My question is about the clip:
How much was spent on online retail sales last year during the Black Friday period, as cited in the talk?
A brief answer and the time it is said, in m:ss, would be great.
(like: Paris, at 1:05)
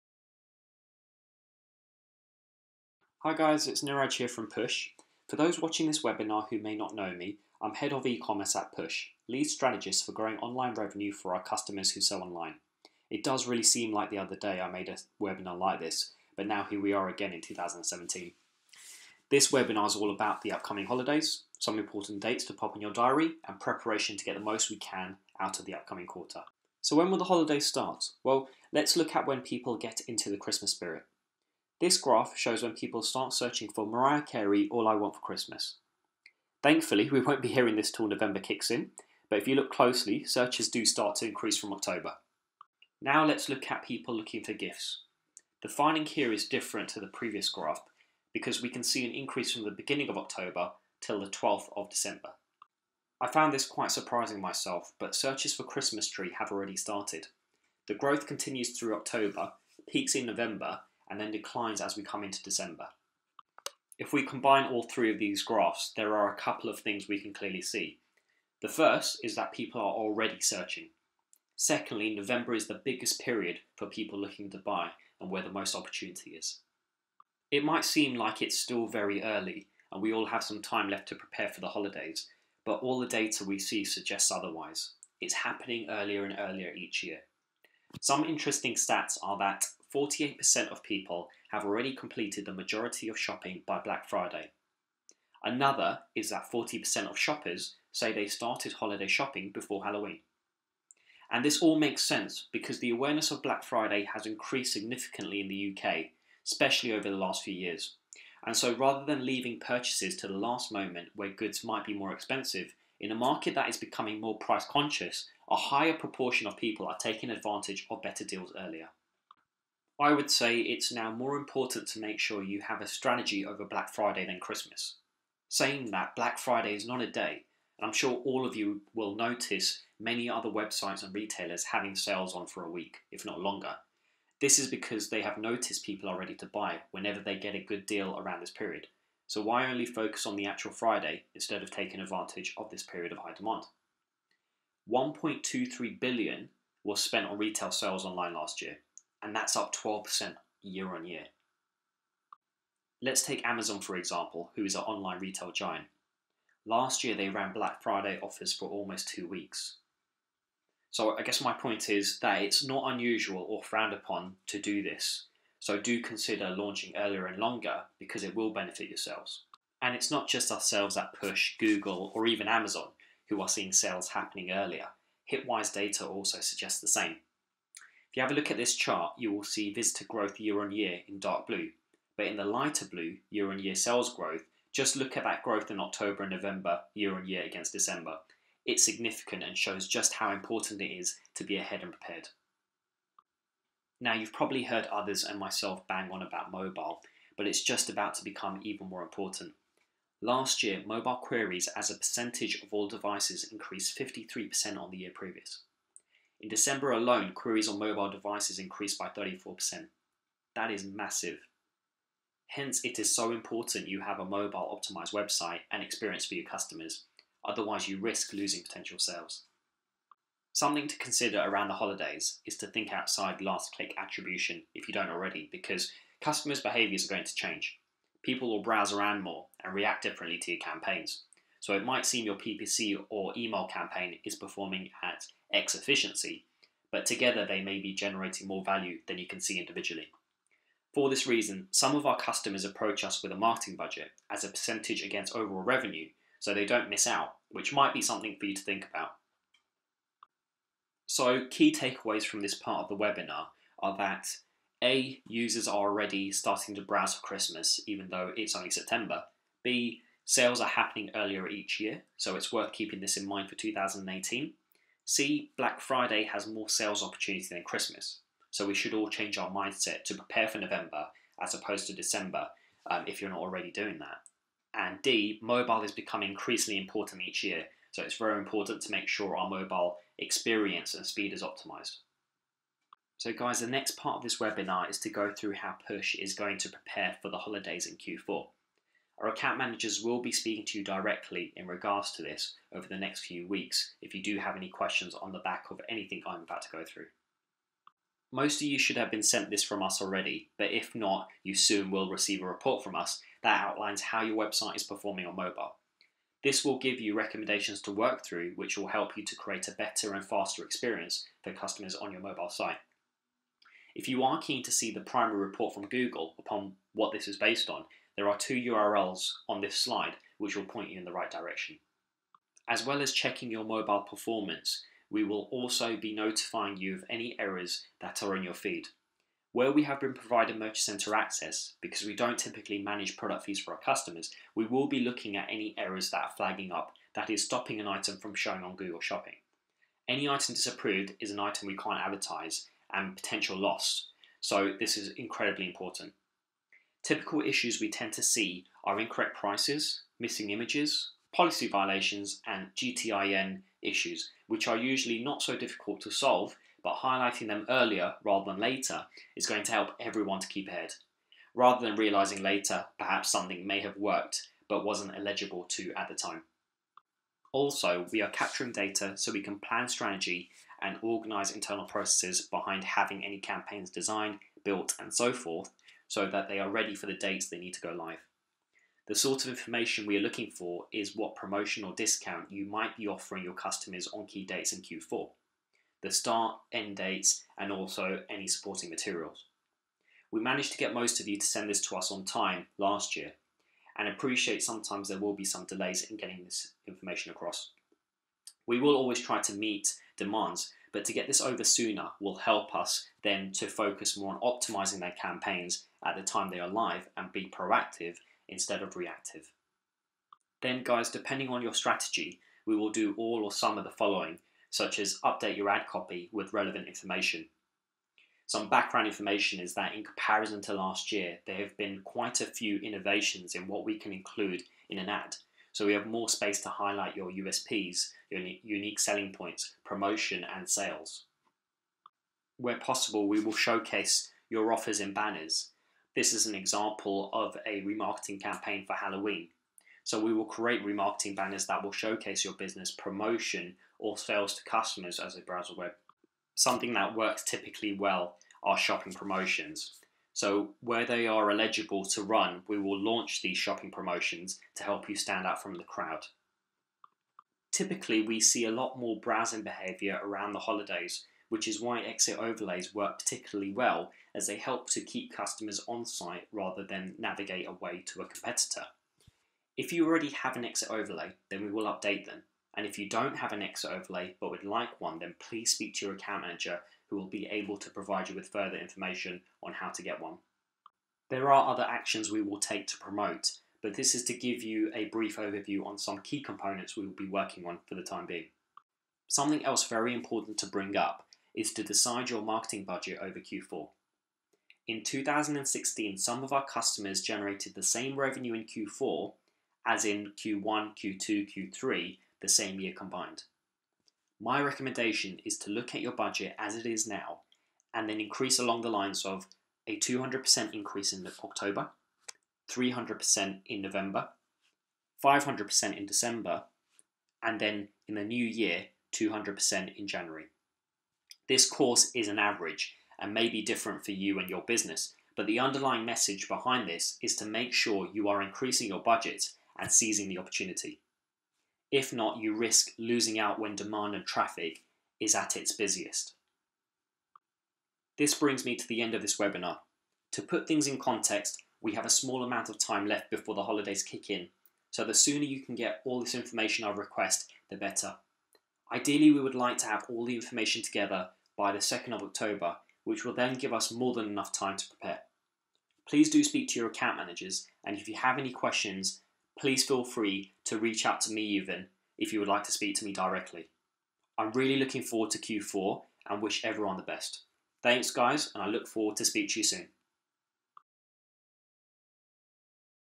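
1.23 billion, at 2:24.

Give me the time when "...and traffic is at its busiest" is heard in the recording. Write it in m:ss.
8:54.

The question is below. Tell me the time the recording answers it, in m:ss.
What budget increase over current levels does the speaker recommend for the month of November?
8:32.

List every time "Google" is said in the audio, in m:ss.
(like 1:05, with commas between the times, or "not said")
2:51, 5:15, 5:38.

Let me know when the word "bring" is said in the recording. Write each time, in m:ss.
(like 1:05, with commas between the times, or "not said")
8:10, 8:58.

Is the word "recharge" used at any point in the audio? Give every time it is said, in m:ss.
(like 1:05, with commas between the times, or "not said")
not said.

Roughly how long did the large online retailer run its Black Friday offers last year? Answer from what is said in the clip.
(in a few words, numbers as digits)
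almost two weeks.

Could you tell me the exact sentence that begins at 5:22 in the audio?
As well as checking your mobile performance, we will also be notifying you of any errors that are in your feed.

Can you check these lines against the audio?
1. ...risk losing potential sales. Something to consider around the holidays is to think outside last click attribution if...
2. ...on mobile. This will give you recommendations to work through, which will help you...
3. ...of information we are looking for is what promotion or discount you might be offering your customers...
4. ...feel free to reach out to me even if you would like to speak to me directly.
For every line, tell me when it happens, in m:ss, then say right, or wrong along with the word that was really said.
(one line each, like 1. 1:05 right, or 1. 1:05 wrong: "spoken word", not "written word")
1. 3:37 right
2. 5:05 right
3. 6:19 right
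4. 9:19 right.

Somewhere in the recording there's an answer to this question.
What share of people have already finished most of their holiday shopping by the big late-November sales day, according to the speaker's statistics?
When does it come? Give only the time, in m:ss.
1:29.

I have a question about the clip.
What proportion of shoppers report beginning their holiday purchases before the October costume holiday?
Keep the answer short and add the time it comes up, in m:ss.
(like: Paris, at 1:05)
40%, at 1:36.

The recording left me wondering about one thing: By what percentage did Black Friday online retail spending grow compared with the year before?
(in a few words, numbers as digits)
12%.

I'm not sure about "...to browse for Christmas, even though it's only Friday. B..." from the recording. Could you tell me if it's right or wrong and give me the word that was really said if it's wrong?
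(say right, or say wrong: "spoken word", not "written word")
wrong: "September", not "Friday".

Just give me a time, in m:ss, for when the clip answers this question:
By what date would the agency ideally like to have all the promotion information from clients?
9:11.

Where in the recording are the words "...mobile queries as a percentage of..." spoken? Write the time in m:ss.
3:20.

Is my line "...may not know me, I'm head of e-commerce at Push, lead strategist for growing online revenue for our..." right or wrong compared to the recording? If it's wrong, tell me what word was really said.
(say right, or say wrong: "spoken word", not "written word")
right.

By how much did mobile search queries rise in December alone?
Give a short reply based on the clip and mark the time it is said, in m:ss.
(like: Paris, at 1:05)
34%, at 3:29.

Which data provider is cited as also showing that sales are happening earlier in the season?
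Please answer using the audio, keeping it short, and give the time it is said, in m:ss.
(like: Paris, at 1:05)
Hitwise, at 2:55.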